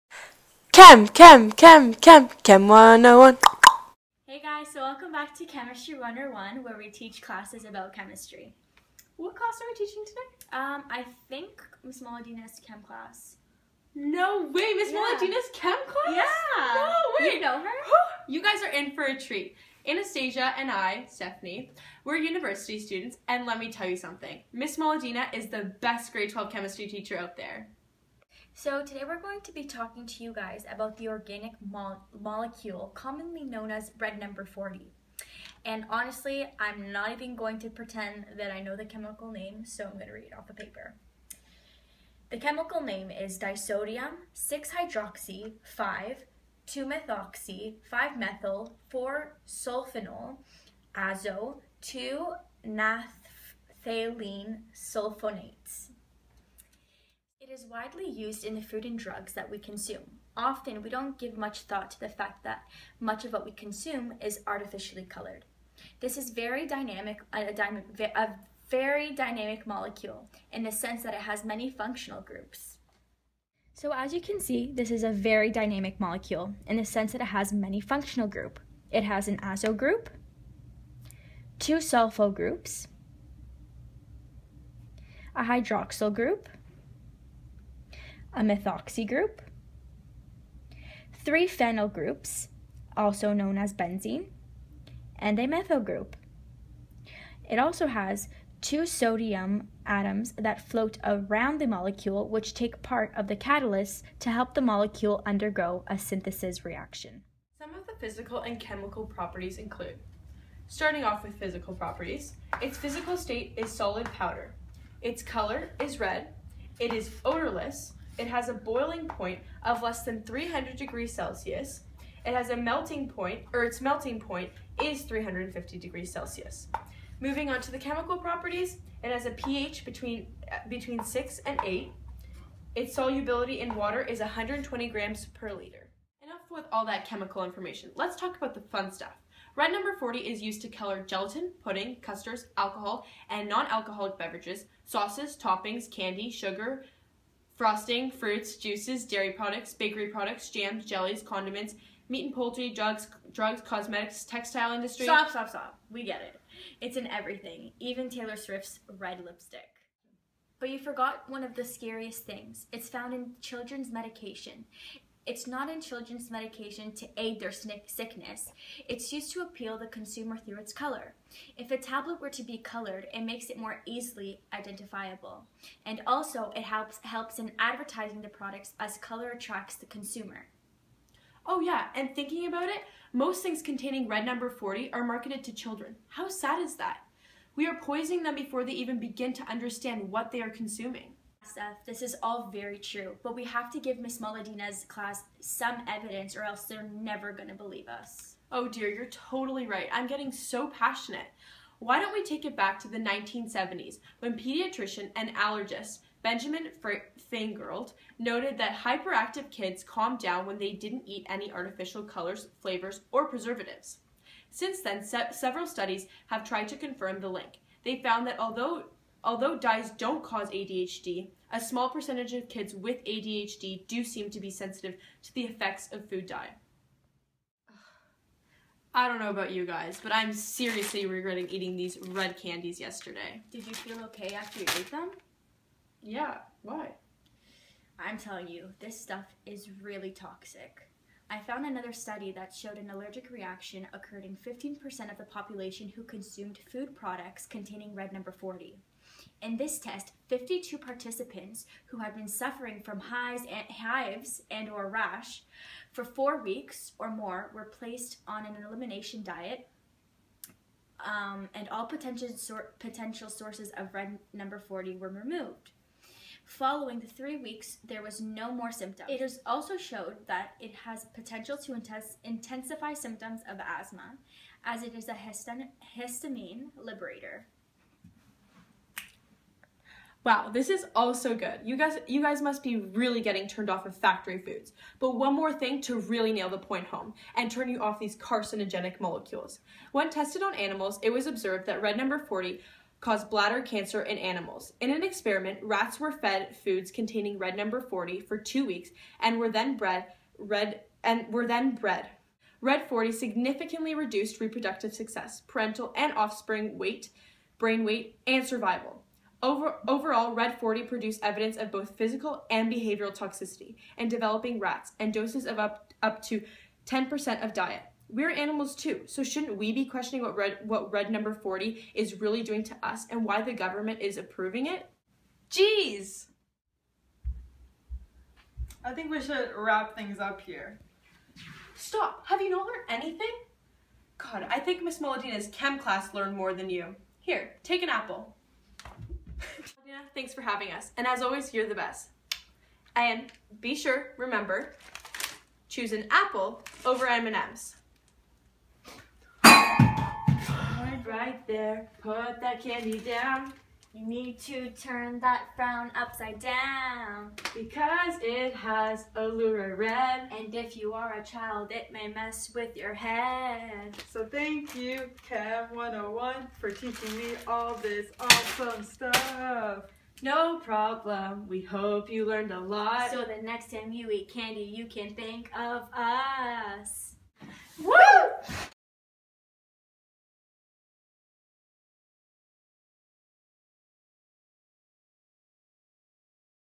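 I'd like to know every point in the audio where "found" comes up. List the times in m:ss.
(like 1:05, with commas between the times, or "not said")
2:42, 3:38, 4:01.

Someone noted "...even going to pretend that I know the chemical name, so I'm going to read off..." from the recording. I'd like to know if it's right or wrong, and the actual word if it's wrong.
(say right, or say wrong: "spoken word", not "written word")
right.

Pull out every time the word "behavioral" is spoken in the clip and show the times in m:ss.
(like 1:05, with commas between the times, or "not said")
5:12.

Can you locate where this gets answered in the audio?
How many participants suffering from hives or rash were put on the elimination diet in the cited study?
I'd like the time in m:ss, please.
4:10.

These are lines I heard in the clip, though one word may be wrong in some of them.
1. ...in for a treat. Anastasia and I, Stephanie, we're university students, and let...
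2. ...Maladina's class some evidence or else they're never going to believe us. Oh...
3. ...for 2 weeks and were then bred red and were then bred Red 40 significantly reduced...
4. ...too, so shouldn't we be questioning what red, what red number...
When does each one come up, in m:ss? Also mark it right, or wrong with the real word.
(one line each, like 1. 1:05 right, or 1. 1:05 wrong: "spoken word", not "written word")
1. 0:18 right
2. 3:14 right
3. 4:58 right
4. 5:18 right.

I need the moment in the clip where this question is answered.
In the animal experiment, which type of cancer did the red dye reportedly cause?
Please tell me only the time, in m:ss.
4:53.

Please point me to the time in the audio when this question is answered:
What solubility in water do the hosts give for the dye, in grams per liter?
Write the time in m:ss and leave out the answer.
2:14.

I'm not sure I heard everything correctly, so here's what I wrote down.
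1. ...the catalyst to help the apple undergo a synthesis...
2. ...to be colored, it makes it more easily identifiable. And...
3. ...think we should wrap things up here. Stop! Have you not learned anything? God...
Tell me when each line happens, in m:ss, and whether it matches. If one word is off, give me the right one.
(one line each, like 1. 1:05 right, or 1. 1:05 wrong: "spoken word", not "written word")
1. 1:43 wrong: "molecule", not "apple"
2. 2:52 right
3. 5:28 right.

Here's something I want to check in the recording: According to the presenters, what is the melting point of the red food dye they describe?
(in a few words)
350 degrees Celsius.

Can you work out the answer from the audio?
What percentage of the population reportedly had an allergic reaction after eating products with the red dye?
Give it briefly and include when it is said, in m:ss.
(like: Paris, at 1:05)
15%, at 4:04.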